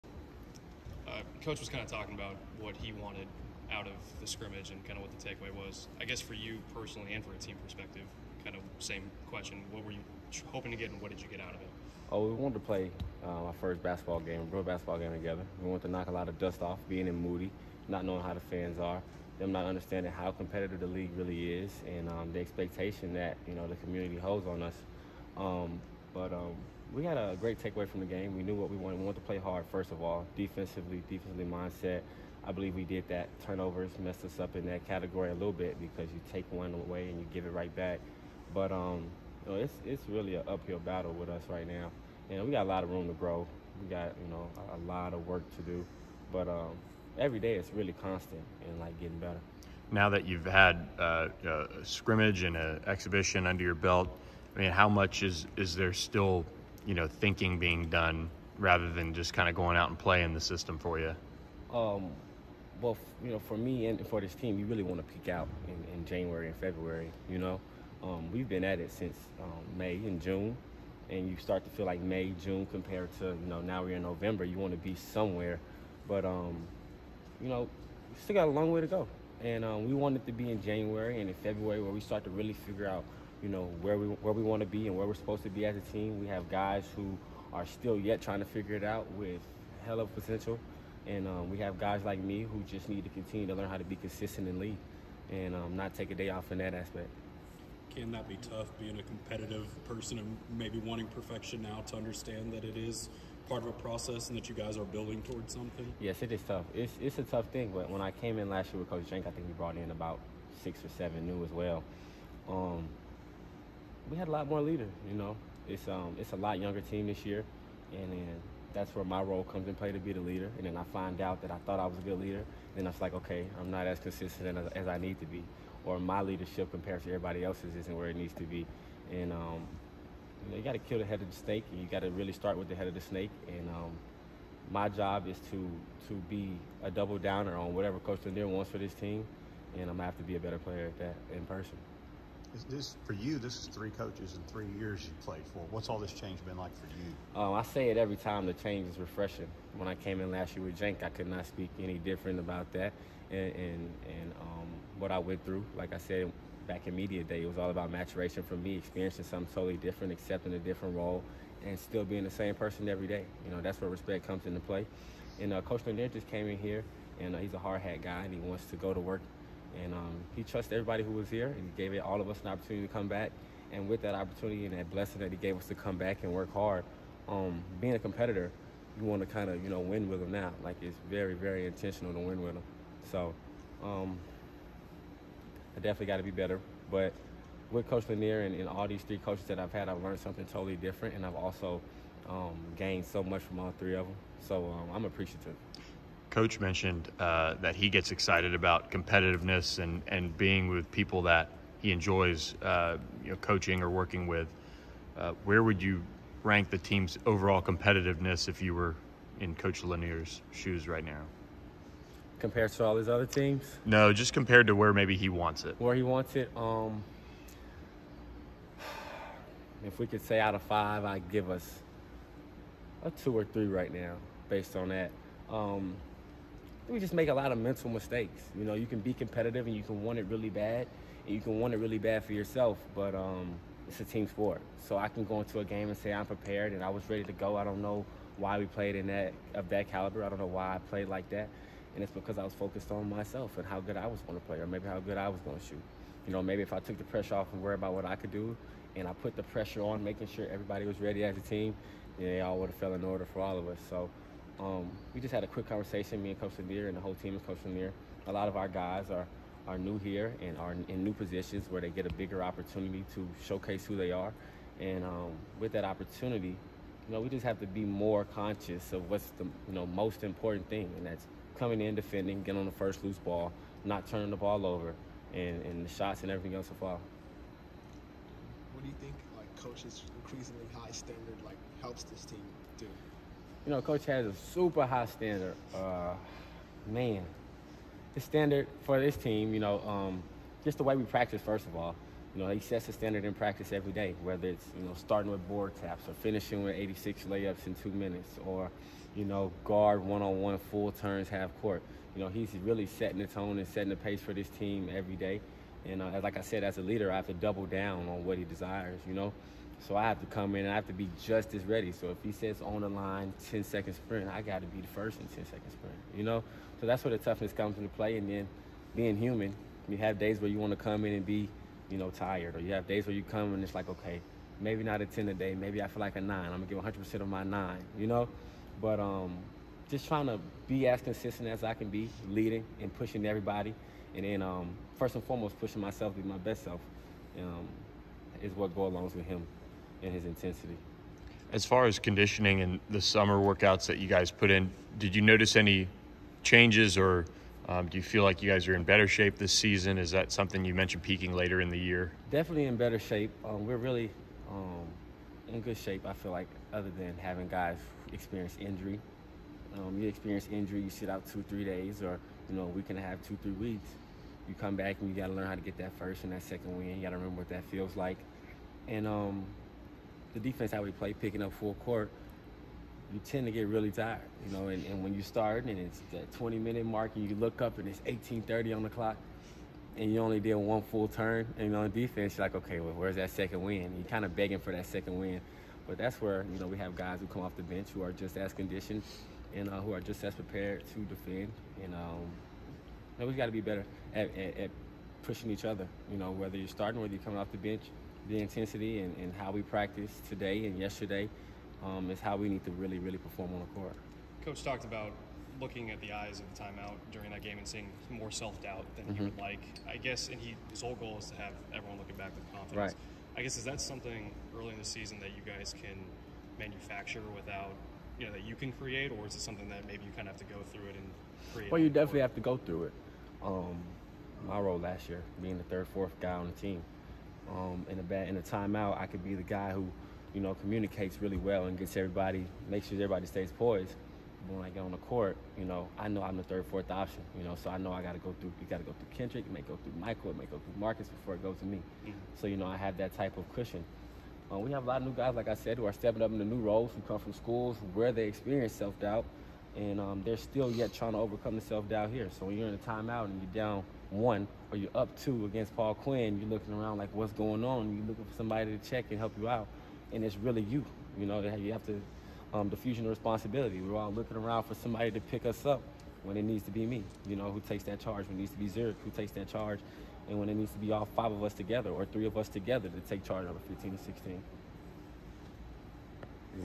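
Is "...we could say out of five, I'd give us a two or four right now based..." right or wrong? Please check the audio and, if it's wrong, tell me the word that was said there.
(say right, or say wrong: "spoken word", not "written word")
wrong: "three", not "four".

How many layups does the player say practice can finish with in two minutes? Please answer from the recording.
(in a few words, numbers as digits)
86.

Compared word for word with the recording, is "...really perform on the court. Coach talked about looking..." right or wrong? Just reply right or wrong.
right.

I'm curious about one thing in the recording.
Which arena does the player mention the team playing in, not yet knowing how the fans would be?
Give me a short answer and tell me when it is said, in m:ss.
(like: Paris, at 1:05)
Moody, at 0:17.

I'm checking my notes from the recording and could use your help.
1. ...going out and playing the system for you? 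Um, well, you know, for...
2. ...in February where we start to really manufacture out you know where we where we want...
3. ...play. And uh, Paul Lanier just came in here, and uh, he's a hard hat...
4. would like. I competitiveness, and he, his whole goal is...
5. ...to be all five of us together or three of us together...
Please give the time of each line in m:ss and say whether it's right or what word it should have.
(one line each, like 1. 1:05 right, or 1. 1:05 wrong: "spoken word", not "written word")
1. 0:59 right
2. 1:21 wrong: "figure", not "manufacture"
3. 2:44 wrong: "Coach", not "Paul"
4. 6:49 wrong: "guess", not "competitiveness"
5. 7:50 right.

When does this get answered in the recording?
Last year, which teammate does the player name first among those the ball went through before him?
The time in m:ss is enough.
7:19.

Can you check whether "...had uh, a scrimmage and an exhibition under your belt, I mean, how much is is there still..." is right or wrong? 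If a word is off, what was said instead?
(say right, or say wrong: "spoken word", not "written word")
right.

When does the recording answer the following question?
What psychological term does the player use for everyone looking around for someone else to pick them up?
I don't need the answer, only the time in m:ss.
7:42.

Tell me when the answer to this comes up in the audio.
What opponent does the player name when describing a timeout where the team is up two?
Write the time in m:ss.
7:35.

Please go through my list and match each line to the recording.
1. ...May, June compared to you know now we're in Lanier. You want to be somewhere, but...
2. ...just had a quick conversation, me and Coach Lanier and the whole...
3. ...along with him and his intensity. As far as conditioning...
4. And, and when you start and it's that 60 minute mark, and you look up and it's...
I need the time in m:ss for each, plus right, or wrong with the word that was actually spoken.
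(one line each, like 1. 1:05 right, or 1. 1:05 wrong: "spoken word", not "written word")
1. 1:12 wrong: "November", not "Lanier"
2. 4:15 right
3. 5:38 right
4. 6:14 wrong: "20", not "60".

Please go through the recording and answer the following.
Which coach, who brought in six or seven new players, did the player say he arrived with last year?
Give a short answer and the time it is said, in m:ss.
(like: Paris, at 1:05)
Coach Jank, at 1:48.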